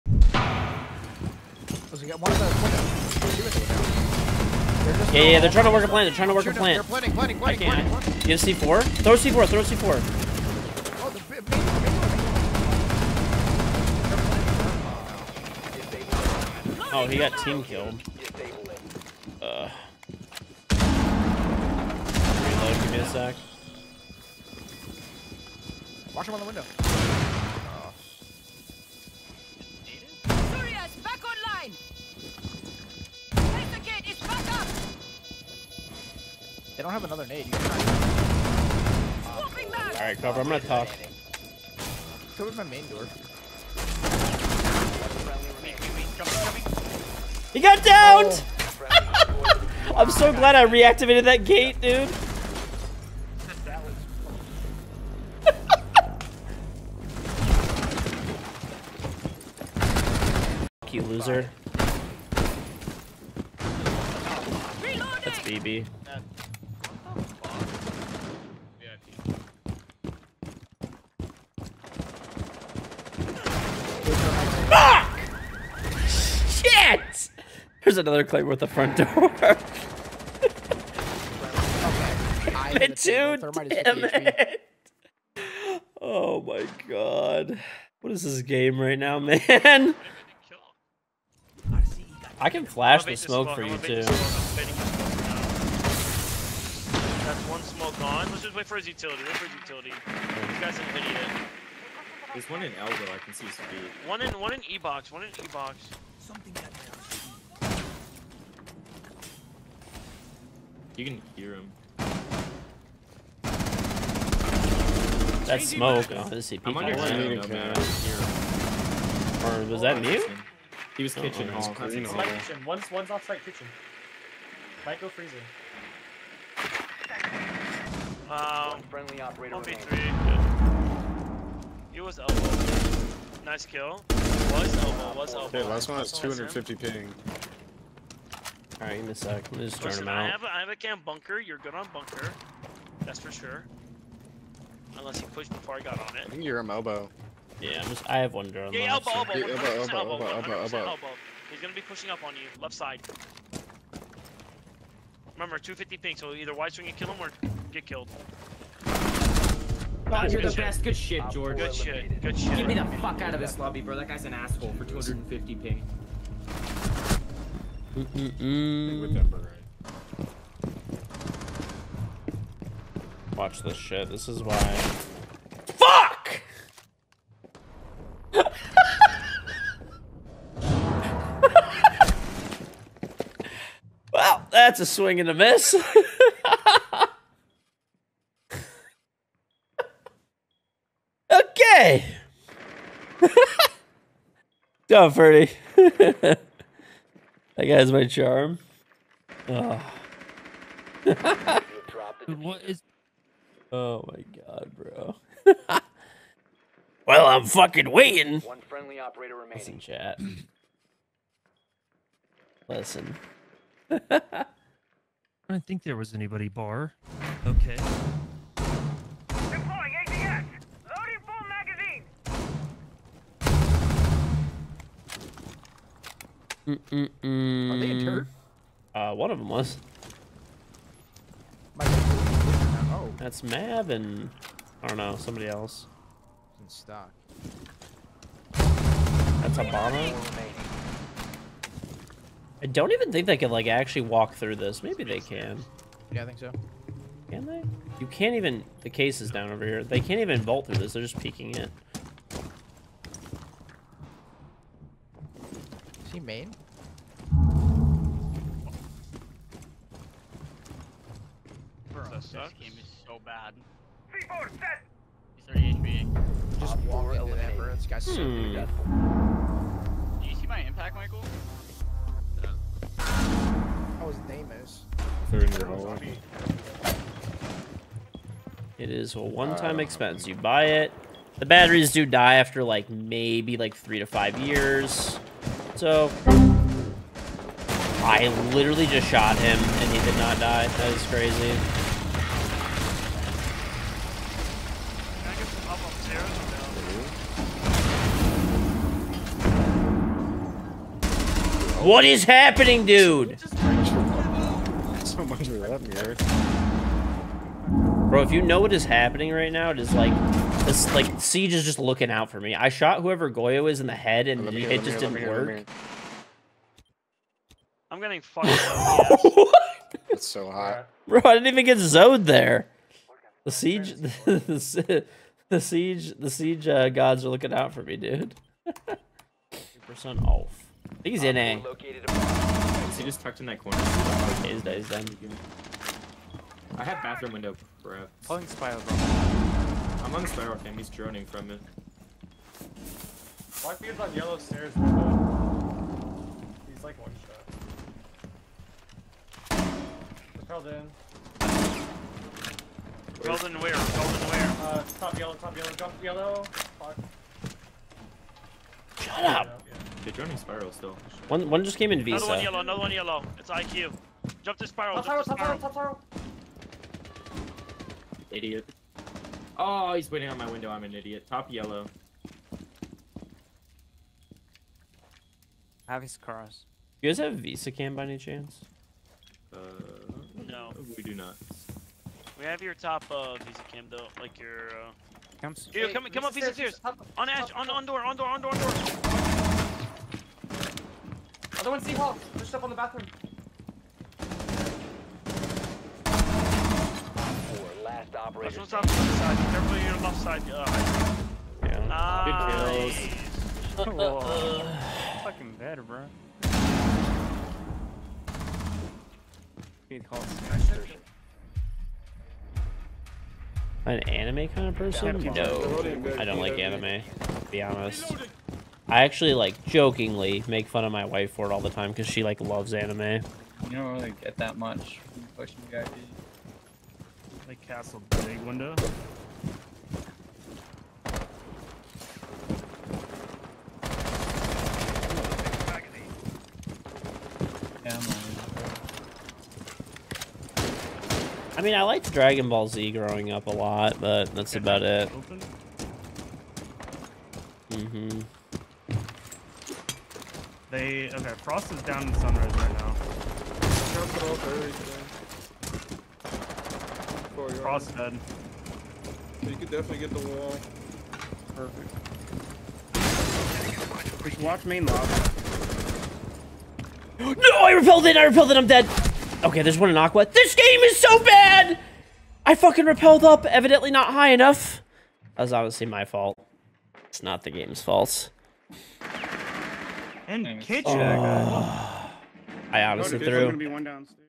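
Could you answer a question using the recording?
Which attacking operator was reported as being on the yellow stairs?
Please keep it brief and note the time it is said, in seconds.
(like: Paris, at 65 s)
Blackbeard, at 343 s.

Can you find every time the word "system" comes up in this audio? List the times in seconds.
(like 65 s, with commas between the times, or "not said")
not said.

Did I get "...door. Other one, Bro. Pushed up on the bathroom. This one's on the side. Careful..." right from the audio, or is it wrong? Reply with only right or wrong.
wrong.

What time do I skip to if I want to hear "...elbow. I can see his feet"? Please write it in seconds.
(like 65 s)
102 s.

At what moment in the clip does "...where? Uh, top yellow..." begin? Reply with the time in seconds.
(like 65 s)
354 s.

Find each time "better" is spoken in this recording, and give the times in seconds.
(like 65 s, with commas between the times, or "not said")
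405 s.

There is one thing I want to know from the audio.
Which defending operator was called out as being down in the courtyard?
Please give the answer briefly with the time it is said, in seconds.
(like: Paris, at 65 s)
Frost, at 451 s.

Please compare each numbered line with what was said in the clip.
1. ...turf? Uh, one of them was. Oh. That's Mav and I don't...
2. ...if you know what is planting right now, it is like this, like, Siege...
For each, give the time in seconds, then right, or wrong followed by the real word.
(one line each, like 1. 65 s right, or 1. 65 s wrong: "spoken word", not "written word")
1. 228 s right
2. 308 s wrong: "happening", not "planting".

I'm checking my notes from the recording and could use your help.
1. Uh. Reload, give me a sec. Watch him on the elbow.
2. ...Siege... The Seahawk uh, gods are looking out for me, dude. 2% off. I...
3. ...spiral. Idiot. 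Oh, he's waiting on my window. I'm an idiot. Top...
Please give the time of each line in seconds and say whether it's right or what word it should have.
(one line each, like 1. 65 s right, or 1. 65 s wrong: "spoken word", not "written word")
1. 19 s wrong: "window", not "elbow"
2. 325 s wrong: "Siege", not "Seahawk"
3. 366 s right.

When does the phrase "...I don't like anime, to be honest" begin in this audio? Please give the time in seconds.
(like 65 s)
416 s.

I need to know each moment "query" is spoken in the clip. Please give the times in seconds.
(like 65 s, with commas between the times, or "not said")
not said.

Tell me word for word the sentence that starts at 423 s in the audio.
You don't really get that much from pushing guy castle big window.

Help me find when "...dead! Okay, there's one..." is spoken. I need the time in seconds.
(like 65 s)
468 s.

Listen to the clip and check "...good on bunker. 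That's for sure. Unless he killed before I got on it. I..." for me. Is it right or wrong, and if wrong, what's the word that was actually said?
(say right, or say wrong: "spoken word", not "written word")
wrong: "pushed", not "killed".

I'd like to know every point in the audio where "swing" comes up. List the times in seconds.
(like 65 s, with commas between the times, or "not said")
156 s, 184 s.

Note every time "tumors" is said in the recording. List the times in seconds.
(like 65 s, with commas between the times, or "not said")
not said.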